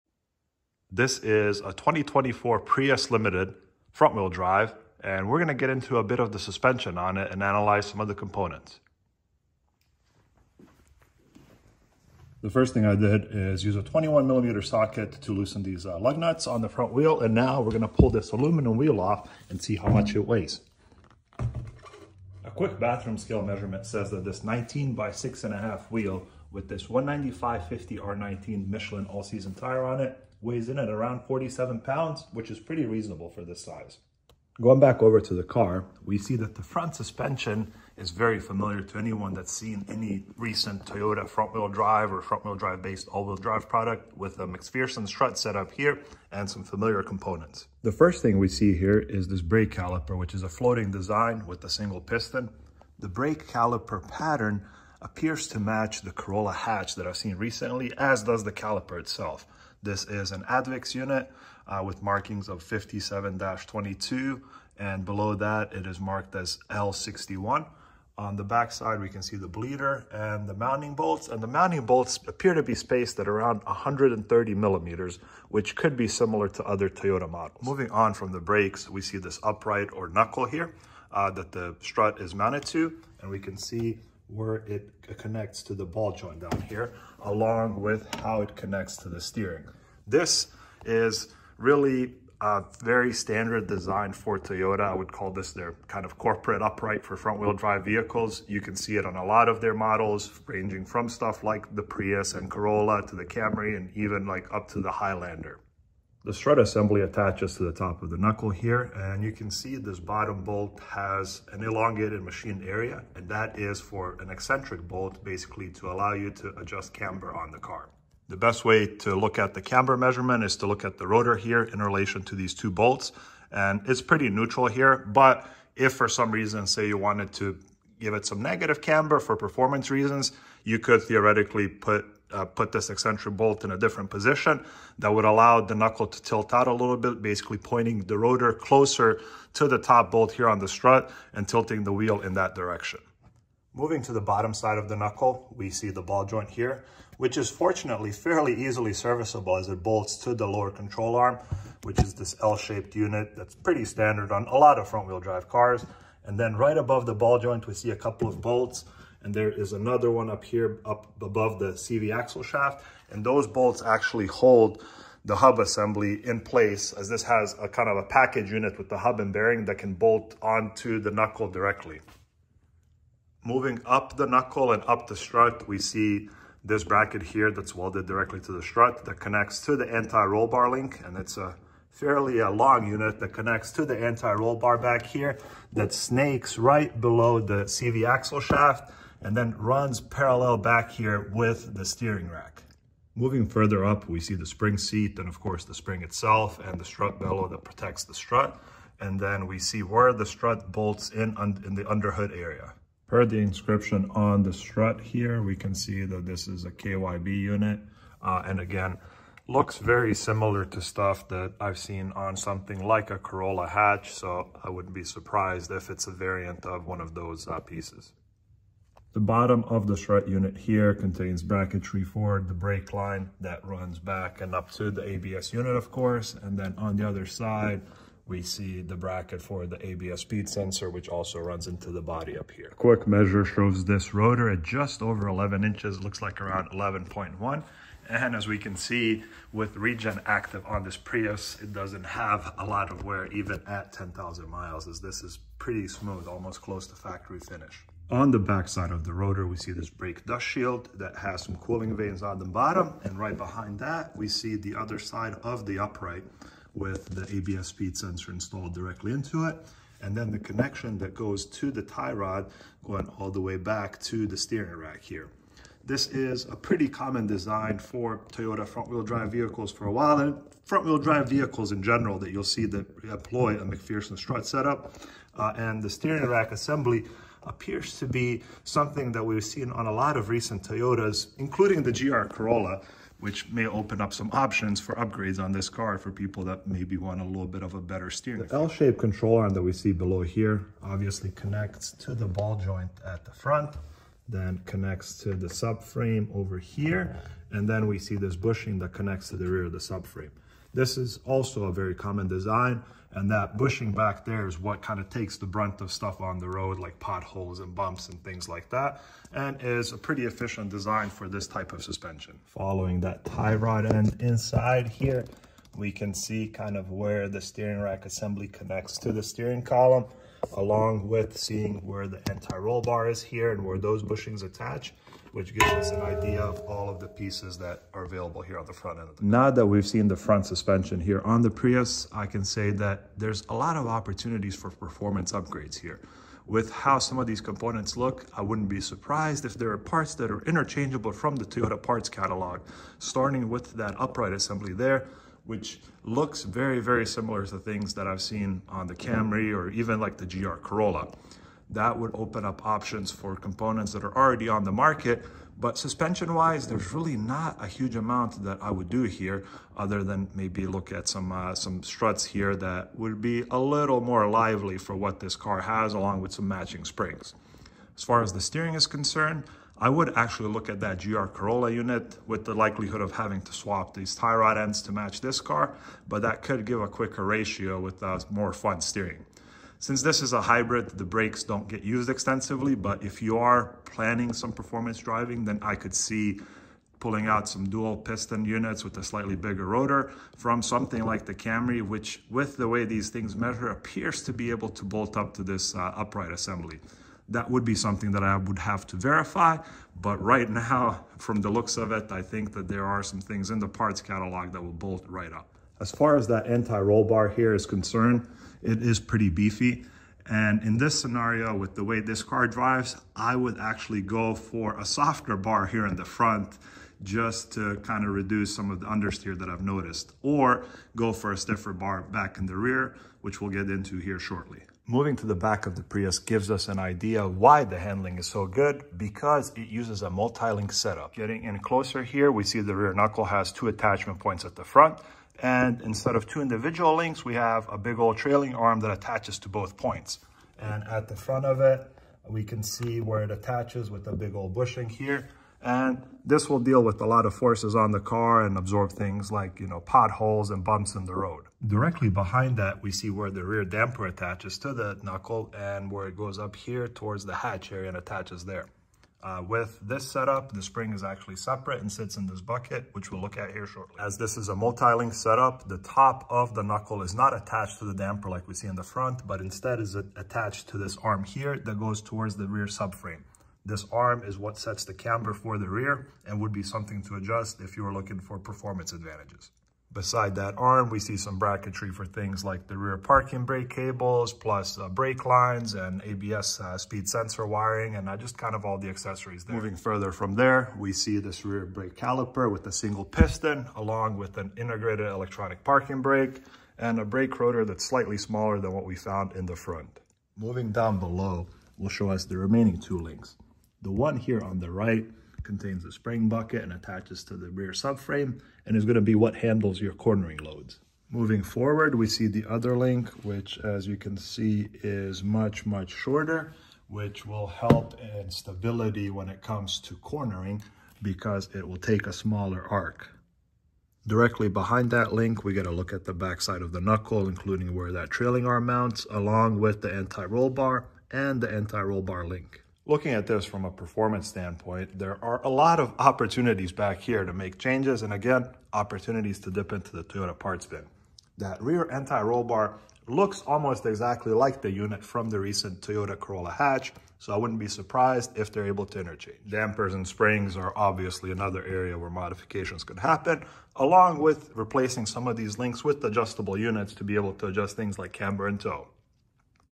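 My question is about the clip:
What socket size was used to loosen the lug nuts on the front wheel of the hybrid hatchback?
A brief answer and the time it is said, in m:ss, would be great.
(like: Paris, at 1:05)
21 millimeter, at 0:13.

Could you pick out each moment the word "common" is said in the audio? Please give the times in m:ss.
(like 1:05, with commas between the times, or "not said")
4:26, 5:01.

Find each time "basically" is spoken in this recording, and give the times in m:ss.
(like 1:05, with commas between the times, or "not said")
1:55, 2:17.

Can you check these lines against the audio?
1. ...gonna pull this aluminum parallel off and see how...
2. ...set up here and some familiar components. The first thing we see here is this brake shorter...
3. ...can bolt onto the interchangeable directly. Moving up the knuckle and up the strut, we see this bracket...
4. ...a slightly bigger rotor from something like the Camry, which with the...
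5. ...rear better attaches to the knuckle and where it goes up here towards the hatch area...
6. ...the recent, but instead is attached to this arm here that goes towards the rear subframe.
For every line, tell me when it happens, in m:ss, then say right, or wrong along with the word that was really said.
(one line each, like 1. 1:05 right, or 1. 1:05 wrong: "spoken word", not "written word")
1. 0:17 wrong: "wheel", not "parallel"
2. 0:45 wrong: "caliper", not "shorter"
3. 2:49 wrong: "knuckle", not "interchangeable"
4. 6:28 right
5. 7:33 wrong: "damper", not "better"
6. 7:48 wrong: "front", not "recent".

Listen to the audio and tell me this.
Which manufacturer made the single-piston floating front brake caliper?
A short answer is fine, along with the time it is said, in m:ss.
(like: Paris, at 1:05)
ADVICS, at 1:00.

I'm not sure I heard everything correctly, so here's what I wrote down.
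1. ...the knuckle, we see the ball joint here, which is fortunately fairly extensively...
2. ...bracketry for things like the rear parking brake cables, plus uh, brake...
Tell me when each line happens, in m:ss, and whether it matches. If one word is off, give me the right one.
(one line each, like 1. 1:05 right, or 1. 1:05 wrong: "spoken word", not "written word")
1. 2:24 wrong: "easily", not "extensively"
2. 8:01 right.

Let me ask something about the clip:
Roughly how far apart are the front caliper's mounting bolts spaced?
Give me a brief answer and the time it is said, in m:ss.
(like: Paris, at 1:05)
130 millimeters, at 1:13.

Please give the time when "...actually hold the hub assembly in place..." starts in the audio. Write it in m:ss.
2:43.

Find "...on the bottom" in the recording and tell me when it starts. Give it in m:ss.
4:12.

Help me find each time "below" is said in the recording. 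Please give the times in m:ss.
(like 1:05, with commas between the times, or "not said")
1:05, 3:07, 4:49, 8:20.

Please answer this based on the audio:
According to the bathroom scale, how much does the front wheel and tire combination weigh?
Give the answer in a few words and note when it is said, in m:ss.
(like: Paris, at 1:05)
47 pounds, at 0:31.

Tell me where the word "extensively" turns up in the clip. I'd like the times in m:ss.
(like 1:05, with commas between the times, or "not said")
6:22.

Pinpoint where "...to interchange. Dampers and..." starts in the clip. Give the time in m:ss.
9:08.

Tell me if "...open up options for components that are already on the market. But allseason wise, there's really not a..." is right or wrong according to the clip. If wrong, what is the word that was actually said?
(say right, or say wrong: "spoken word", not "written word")
wrong: "suspension", not "allseason".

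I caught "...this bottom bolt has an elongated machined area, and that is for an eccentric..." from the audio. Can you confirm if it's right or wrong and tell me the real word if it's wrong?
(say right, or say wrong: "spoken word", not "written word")
right.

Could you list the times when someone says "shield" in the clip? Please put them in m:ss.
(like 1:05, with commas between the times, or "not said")
4:10.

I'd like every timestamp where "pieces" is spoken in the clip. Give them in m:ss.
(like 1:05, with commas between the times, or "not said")
3:37, 5:27.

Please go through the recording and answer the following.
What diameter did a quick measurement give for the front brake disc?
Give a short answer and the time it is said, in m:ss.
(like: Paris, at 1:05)
11.1 inches, at 3:56.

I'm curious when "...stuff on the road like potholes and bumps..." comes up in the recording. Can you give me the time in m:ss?
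5:05.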